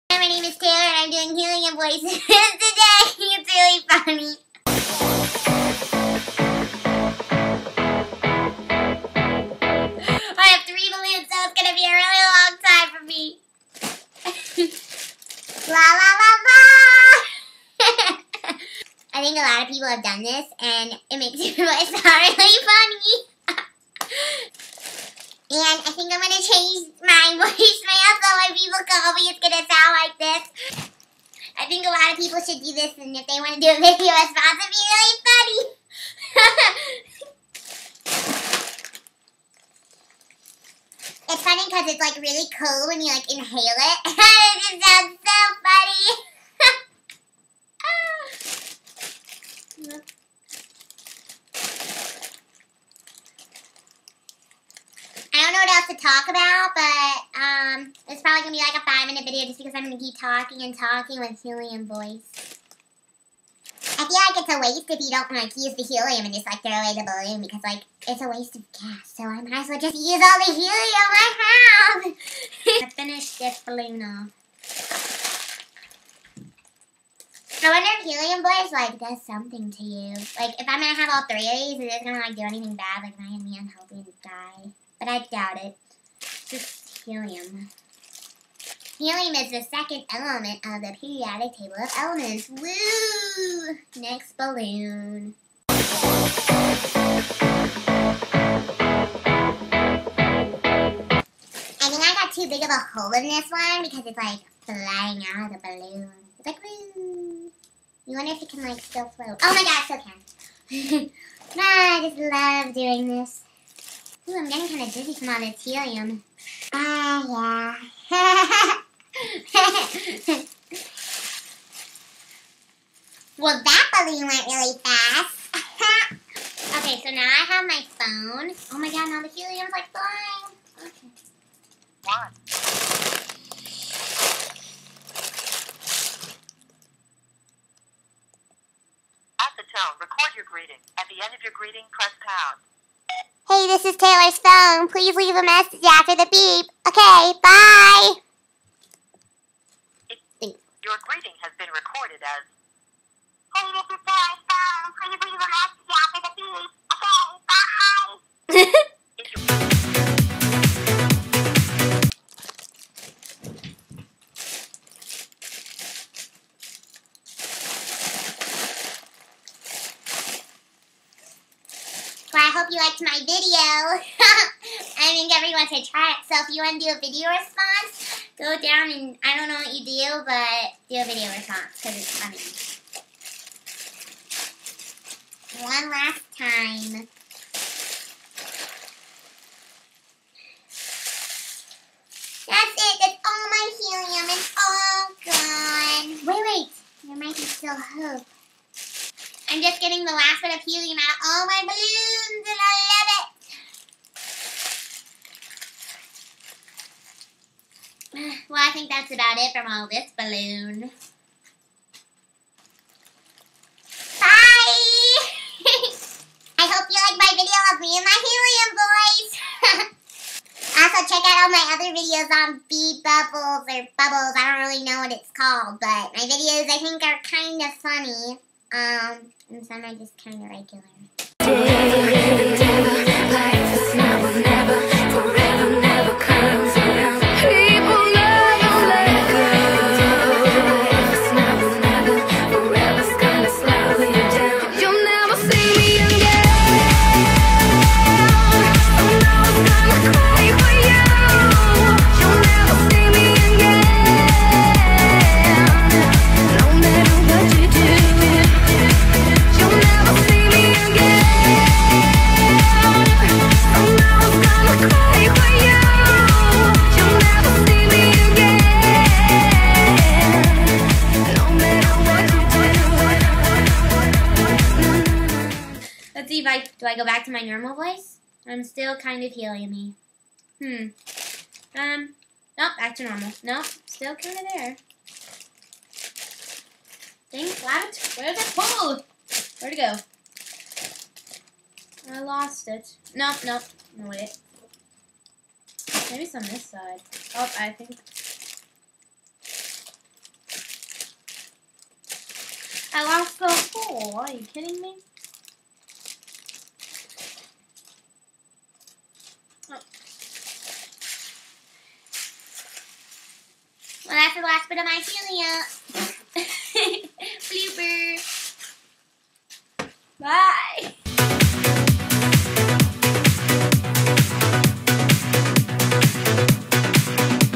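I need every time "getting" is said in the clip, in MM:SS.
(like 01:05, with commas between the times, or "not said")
01:54, 03:19.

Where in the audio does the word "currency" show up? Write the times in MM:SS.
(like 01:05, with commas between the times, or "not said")
not said.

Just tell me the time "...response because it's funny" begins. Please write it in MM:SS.
03:01.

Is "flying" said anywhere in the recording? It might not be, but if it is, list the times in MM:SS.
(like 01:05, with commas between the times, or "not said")
01:44, 02:09.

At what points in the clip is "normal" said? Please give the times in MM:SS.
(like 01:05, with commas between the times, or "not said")
04:37, 04:43.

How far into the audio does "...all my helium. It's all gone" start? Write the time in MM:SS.
03:13.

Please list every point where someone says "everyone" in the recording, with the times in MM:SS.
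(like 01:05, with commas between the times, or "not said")
02:55.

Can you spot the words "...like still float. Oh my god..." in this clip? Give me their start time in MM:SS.
01:48.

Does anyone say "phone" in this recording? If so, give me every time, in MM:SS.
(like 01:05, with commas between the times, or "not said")
02:07, 02:24.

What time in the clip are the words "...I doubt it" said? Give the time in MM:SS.
01:25.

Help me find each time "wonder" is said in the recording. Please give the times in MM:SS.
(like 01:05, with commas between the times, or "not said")
01:17, 01:48.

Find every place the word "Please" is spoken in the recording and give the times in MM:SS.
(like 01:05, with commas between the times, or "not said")
02:24.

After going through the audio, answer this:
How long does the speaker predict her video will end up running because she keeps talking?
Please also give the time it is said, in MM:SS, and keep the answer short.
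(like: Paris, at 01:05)
5 minutes, at 00:58.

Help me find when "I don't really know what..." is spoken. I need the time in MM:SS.
03:44.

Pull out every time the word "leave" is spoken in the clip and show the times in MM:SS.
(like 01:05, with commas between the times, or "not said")
02:25, 04:36.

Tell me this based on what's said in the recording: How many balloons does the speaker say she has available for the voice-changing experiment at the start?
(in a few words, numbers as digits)
3.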